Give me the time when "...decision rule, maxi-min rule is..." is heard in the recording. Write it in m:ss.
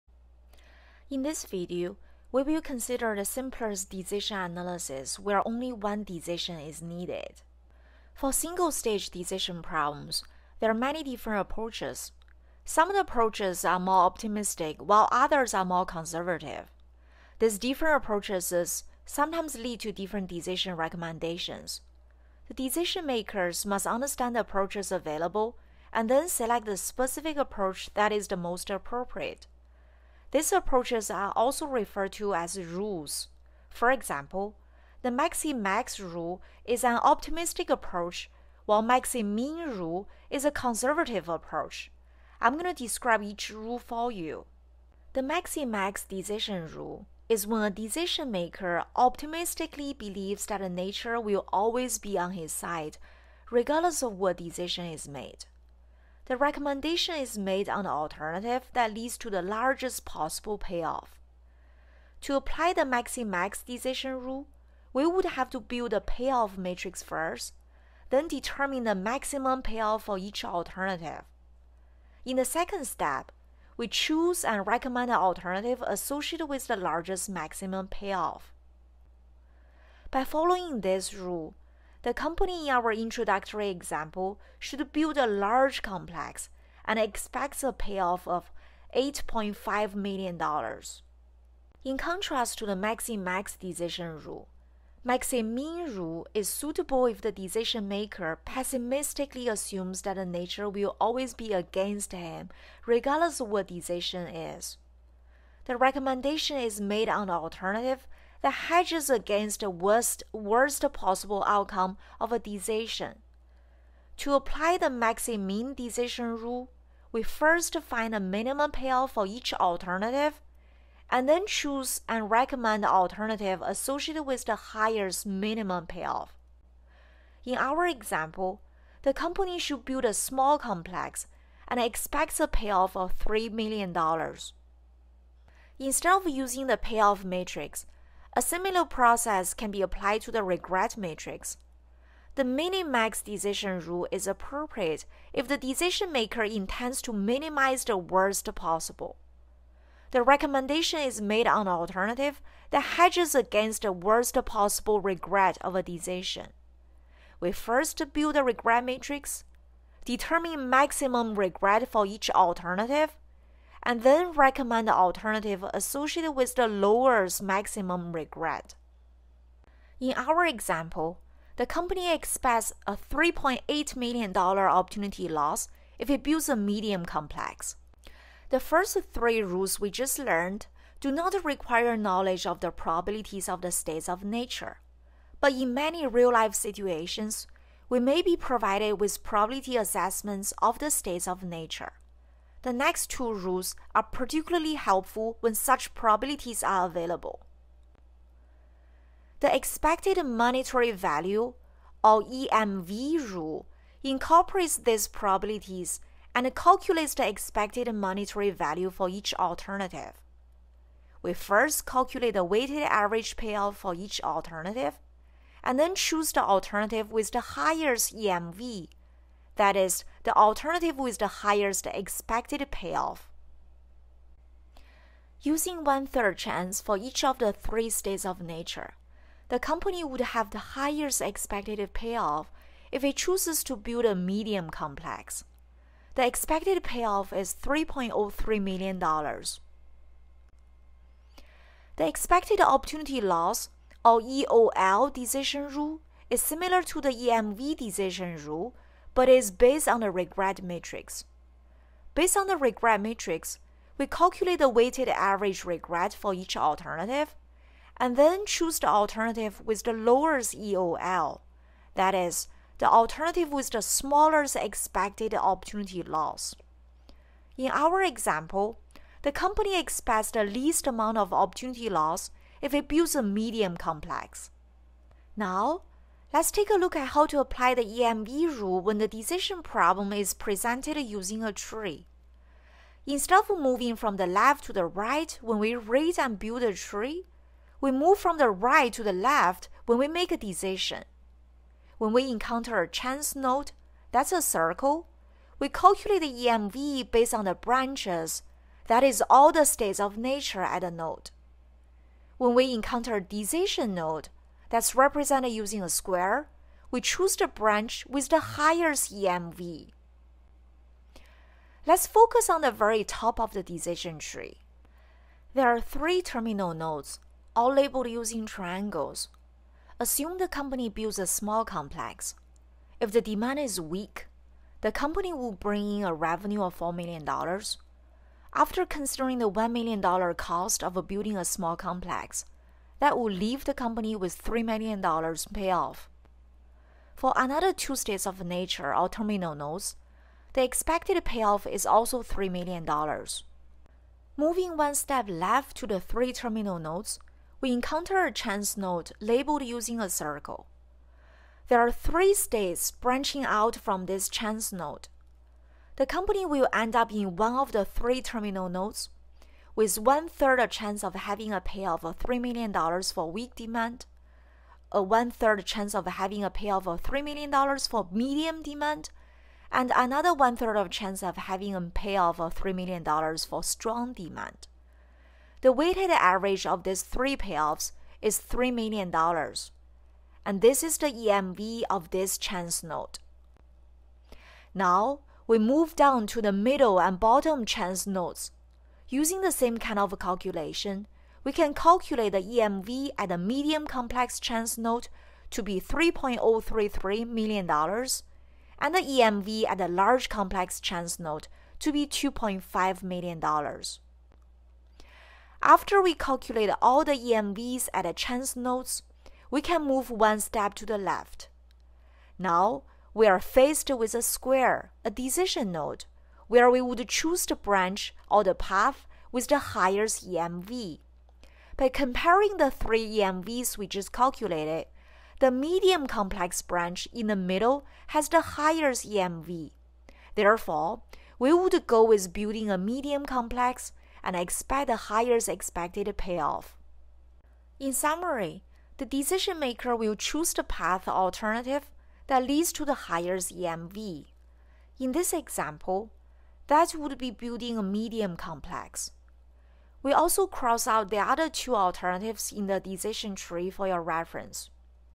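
1:33.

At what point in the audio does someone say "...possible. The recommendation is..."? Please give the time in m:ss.
2:28.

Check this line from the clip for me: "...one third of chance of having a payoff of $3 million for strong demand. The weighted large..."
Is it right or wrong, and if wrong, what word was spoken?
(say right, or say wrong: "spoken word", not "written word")
wrong: "average", not "large".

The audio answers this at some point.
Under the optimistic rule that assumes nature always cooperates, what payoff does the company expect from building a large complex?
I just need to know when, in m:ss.
1:28.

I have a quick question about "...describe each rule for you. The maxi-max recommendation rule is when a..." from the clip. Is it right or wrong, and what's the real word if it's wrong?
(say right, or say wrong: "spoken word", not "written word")
wrong: "decision", not "recommendation".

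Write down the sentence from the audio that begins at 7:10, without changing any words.
Therefore, we would go with building a medium complex and expect the highest expected payoff.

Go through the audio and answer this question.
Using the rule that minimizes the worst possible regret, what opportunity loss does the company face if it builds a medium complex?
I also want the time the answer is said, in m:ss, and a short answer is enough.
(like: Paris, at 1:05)
$3.8 million, at 2:52.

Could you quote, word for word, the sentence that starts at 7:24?
In this example, that would be building a medium complex.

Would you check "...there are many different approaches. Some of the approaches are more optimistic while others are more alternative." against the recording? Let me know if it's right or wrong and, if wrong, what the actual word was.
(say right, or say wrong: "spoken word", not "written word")
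wrong: "conservative", not "alternative".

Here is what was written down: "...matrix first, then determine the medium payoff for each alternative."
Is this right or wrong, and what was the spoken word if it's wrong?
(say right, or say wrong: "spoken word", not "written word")
wrong: "maximum", not "medium".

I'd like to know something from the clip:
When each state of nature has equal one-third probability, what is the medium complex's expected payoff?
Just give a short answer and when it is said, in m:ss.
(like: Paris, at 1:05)
$3.03 million, at 3:57.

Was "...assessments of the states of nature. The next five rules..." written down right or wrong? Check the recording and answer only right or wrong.
wrong.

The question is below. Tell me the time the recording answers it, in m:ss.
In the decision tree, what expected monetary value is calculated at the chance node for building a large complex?
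6:42.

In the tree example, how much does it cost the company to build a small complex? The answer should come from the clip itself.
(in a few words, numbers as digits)
$1 million.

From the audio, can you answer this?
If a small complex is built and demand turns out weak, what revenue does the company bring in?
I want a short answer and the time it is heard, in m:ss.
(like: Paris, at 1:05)
$4 million, at 5:26.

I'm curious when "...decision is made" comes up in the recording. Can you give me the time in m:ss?
0:54.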